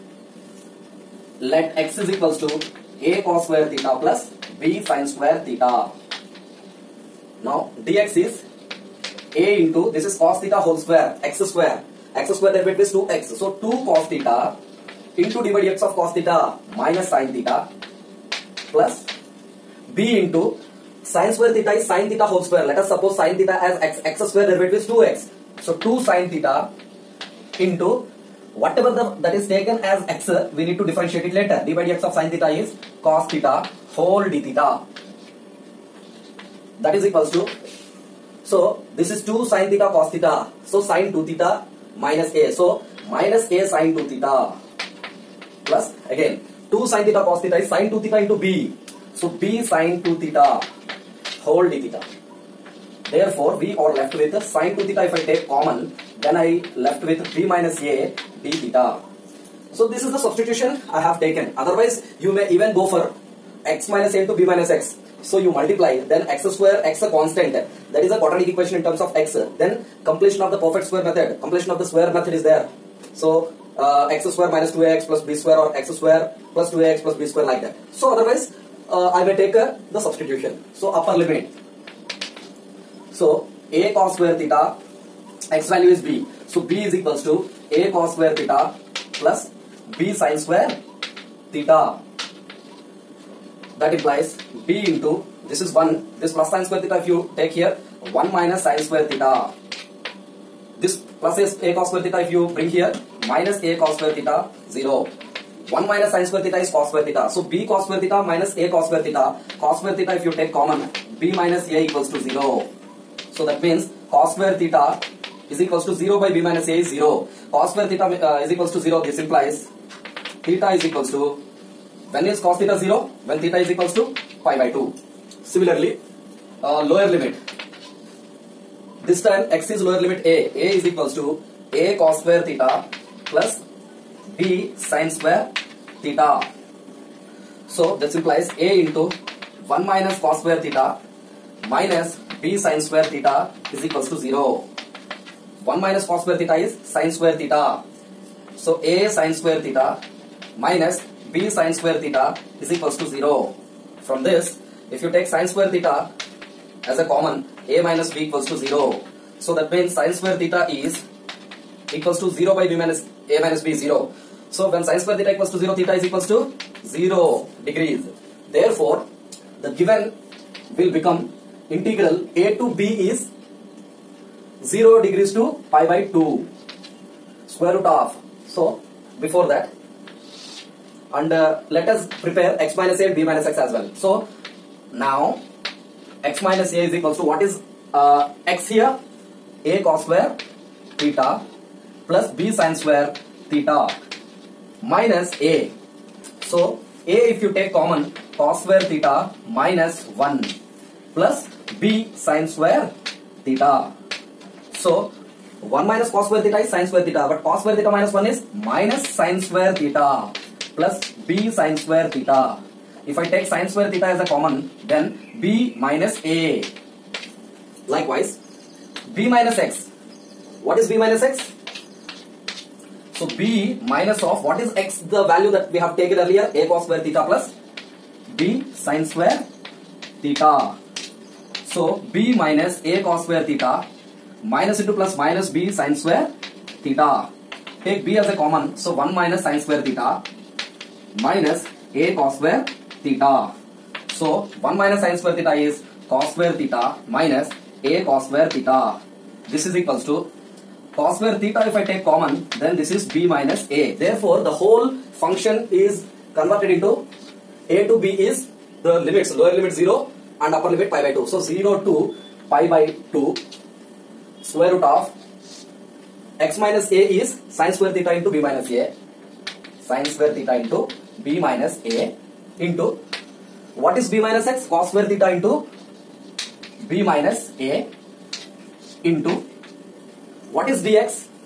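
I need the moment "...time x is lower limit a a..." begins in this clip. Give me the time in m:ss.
2:09.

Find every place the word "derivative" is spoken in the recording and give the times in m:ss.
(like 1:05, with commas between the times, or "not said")
0:12, 0:24.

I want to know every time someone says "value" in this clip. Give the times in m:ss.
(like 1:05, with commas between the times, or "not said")
1:25, 3:45.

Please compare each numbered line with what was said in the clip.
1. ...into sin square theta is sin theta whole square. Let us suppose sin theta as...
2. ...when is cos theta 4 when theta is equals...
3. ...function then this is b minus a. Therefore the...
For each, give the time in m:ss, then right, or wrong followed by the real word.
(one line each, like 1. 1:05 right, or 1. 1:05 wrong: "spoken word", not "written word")
1. 0:20 right
2. 2:02 wrong: "0", not "4"
3. 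4:12 wrong: "common", not "function".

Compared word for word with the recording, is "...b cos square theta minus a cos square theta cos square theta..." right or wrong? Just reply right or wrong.
right.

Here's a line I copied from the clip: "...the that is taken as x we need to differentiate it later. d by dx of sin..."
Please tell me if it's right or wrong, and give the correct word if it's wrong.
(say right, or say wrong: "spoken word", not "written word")
right.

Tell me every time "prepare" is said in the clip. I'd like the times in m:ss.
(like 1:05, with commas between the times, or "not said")
3:02.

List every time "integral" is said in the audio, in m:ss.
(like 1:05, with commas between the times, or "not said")
2:51.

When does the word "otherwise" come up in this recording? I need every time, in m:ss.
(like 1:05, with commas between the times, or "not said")
1:01, 1:18.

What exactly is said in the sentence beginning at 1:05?
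So you multiply, then x square, x a constant.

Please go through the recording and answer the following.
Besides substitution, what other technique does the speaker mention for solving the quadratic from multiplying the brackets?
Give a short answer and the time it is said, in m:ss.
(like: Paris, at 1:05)
Completion of the square, at 1:11.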